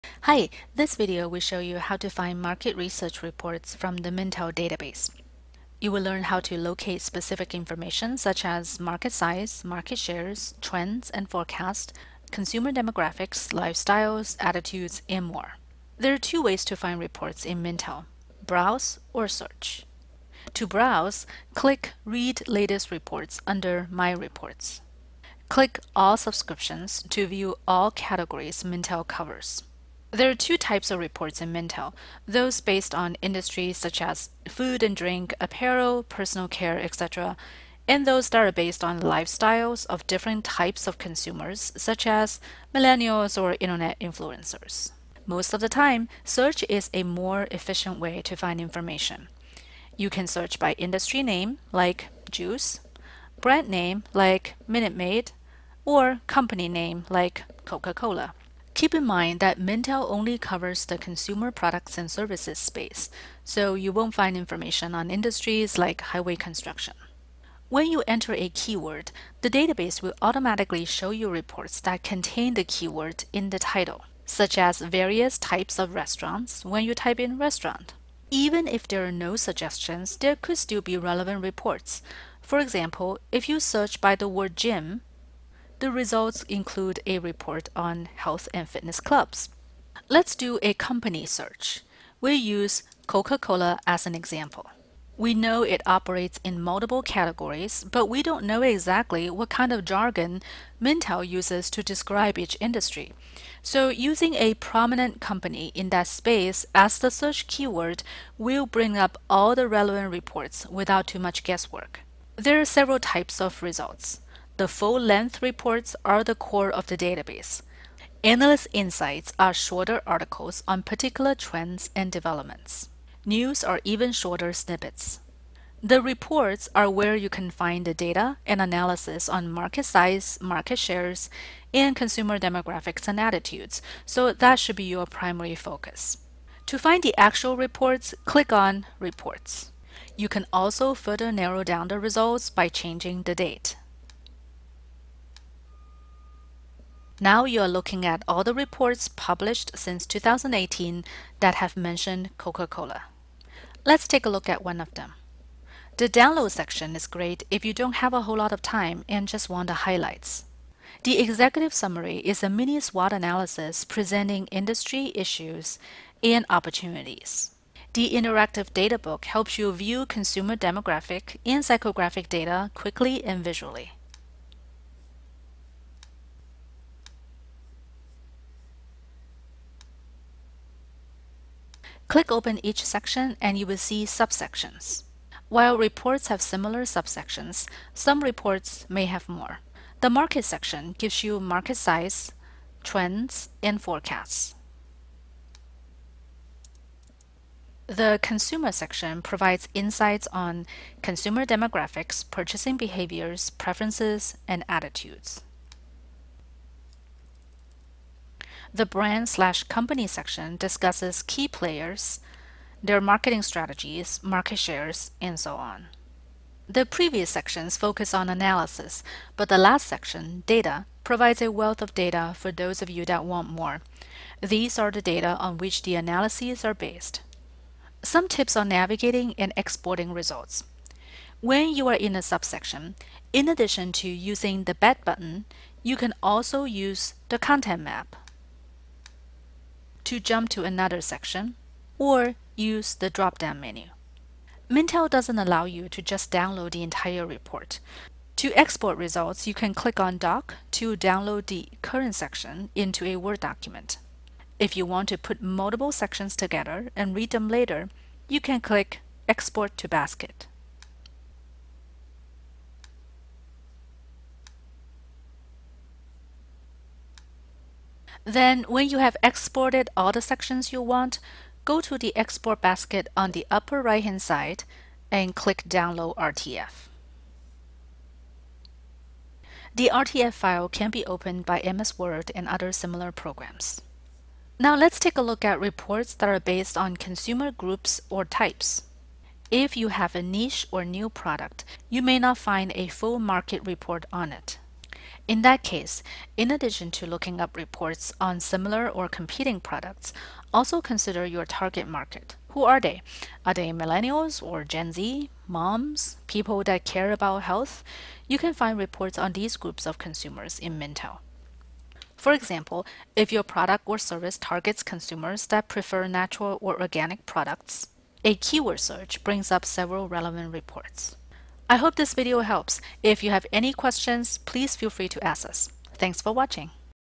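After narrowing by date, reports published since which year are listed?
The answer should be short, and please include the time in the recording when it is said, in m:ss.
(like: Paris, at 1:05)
2018, at 2:30.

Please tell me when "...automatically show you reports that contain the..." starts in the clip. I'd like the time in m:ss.
1:10.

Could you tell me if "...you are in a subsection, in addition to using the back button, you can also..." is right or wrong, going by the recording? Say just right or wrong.
right.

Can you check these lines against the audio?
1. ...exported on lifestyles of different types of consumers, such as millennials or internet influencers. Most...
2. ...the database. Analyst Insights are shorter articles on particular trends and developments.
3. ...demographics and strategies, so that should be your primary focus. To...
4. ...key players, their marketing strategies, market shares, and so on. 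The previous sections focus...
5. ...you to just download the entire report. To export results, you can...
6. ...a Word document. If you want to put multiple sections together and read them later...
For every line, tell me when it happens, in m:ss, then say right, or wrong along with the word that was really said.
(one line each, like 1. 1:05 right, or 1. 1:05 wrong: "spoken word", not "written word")
1. 0:38 wrong: "based", not "exported"
2. 1:56 right
3. 2:12 wrong: "attitudes", not "strategies"
4. 3:31 right
5. 4:05 right
6. 4:13 right.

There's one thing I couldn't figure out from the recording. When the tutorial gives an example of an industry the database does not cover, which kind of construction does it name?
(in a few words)
Highway construction.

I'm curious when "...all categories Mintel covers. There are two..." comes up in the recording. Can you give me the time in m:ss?
0:27.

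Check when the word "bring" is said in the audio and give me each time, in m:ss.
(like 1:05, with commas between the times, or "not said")
1:48, 5:19.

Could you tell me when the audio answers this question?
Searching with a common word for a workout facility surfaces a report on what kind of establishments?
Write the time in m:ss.
1:28.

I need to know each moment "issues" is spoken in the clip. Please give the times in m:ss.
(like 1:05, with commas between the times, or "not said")
2:45.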